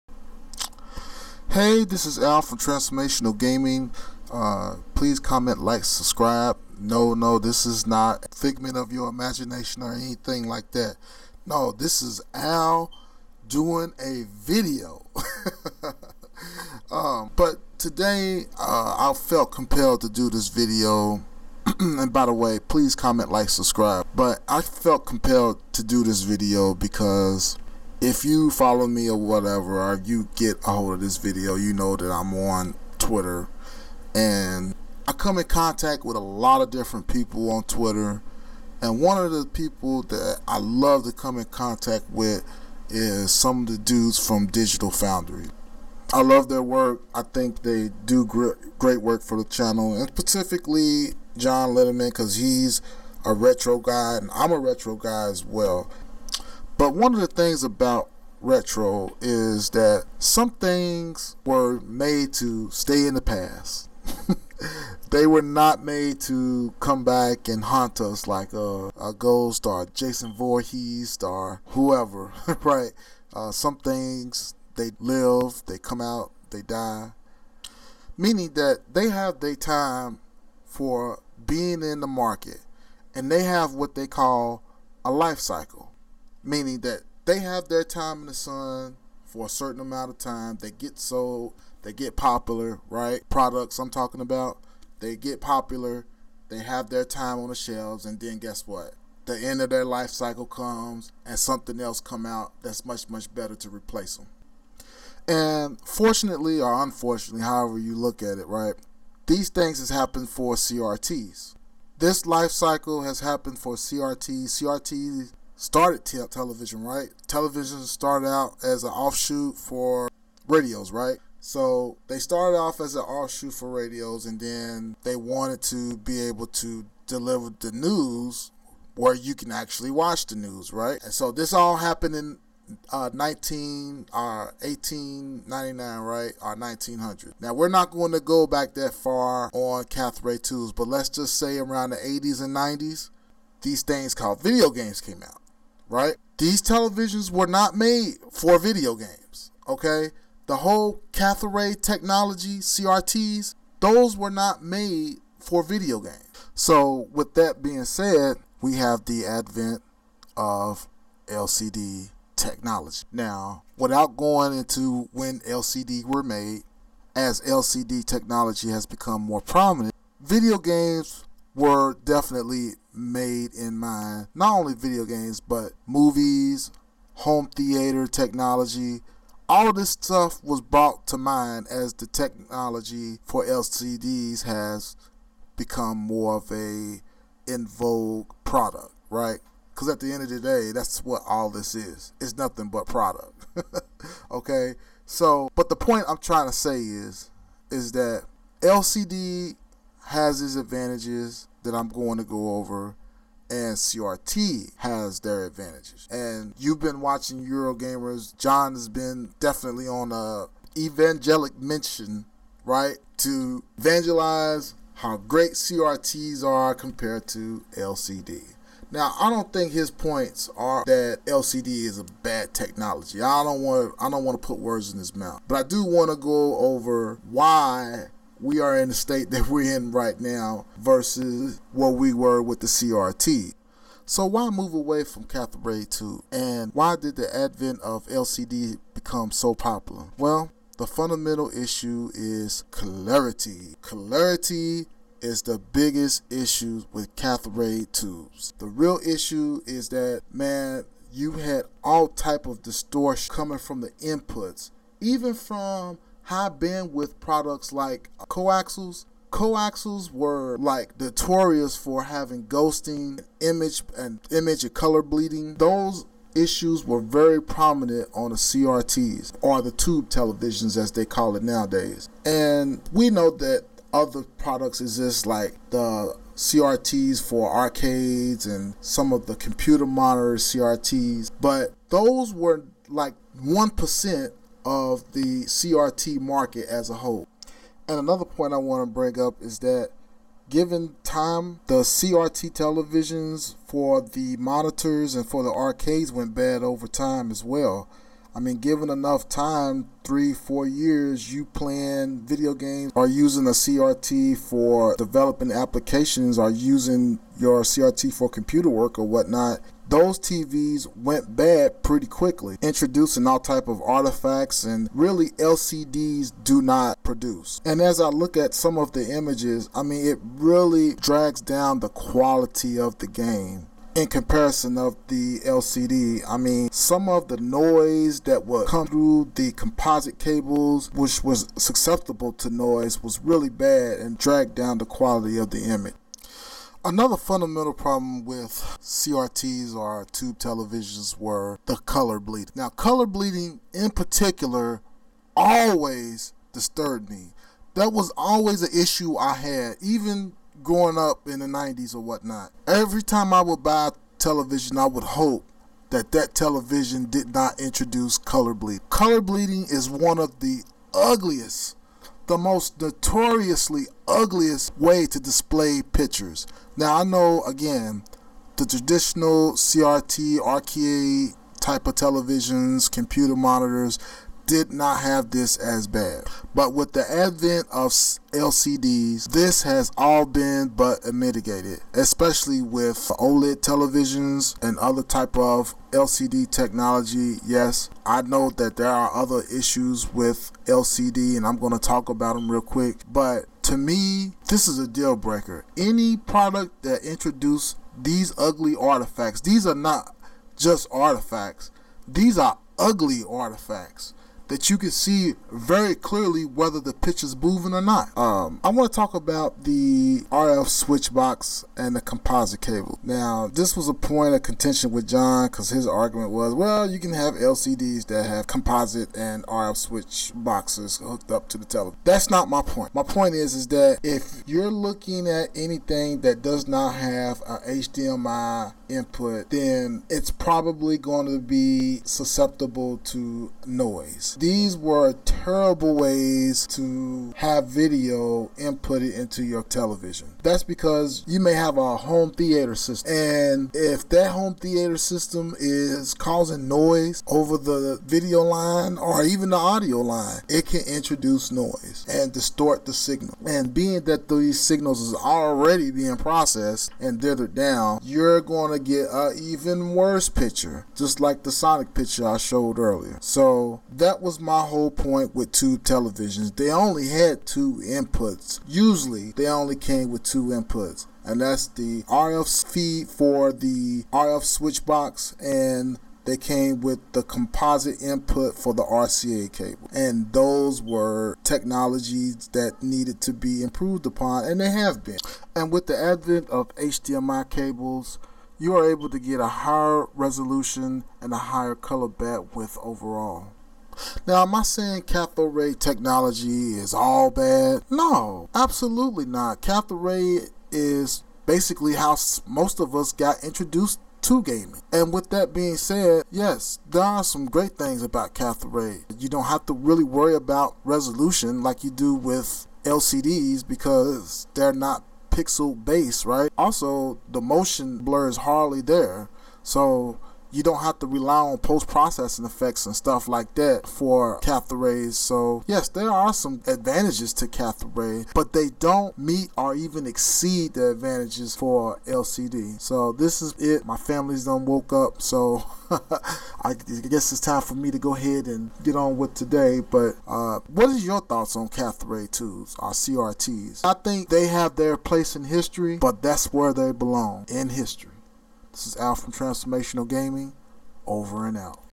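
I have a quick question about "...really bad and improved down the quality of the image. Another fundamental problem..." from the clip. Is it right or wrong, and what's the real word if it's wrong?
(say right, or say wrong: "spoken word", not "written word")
wrong: "dragged", not "improved".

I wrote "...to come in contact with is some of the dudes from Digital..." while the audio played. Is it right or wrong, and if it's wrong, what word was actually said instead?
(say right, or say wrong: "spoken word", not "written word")
right.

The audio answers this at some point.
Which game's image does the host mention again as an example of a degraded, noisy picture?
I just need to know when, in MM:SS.
07:41.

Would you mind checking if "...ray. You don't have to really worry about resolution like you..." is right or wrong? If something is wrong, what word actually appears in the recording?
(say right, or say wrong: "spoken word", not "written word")
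right.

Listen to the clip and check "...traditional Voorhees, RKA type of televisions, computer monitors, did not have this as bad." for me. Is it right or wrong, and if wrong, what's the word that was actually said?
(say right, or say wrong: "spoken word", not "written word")
wrong: "CRT", not "Voorhees".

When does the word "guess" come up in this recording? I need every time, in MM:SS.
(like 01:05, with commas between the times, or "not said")
01:38, 08:56.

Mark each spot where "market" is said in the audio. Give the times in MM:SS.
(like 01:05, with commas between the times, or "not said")
01:22, 04:46.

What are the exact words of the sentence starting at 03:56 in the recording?
And why did the advent of LCD become so popular?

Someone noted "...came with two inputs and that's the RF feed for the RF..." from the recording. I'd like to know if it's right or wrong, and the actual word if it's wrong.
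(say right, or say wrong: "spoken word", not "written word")
right.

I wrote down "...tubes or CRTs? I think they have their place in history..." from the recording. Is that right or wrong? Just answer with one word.
right.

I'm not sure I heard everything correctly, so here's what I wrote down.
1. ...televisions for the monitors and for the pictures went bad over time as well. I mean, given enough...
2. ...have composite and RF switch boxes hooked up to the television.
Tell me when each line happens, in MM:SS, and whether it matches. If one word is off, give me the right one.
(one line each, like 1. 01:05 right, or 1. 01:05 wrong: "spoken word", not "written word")
1. 04:52 wrong: "arcades", not "pictures"
2. 06:58 right.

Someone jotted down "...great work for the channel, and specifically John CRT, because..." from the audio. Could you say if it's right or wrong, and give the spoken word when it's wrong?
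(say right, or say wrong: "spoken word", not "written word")
wrong: "Linneman", not "CRT".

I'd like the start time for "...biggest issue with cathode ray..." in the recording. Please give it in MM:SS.
04:05.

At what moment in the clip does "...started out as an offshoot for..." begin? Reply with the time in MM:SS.
01:57.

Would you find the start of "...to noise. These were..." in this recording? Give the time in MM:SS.
07:13.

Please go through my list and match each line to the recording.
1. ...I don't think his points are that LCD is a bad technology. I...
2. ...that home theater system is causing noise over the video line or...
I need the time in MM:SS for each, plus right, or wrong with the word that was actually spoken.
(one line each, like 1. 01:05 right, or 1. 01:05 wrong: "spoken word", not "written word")
1. 03:39 right
2. 07:24 right.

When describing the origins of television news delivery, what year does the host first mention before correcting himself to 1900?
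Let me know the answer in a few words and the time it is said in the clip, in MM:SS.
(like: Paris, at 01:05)
1899, at 02:14.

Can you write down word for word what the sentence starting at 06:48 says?
Um, I want to talk about the RF switch box and the composite cable.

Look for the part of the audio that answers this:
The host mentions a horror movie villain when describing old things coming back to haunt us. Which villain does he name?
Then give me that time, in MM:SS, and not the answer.
01:09.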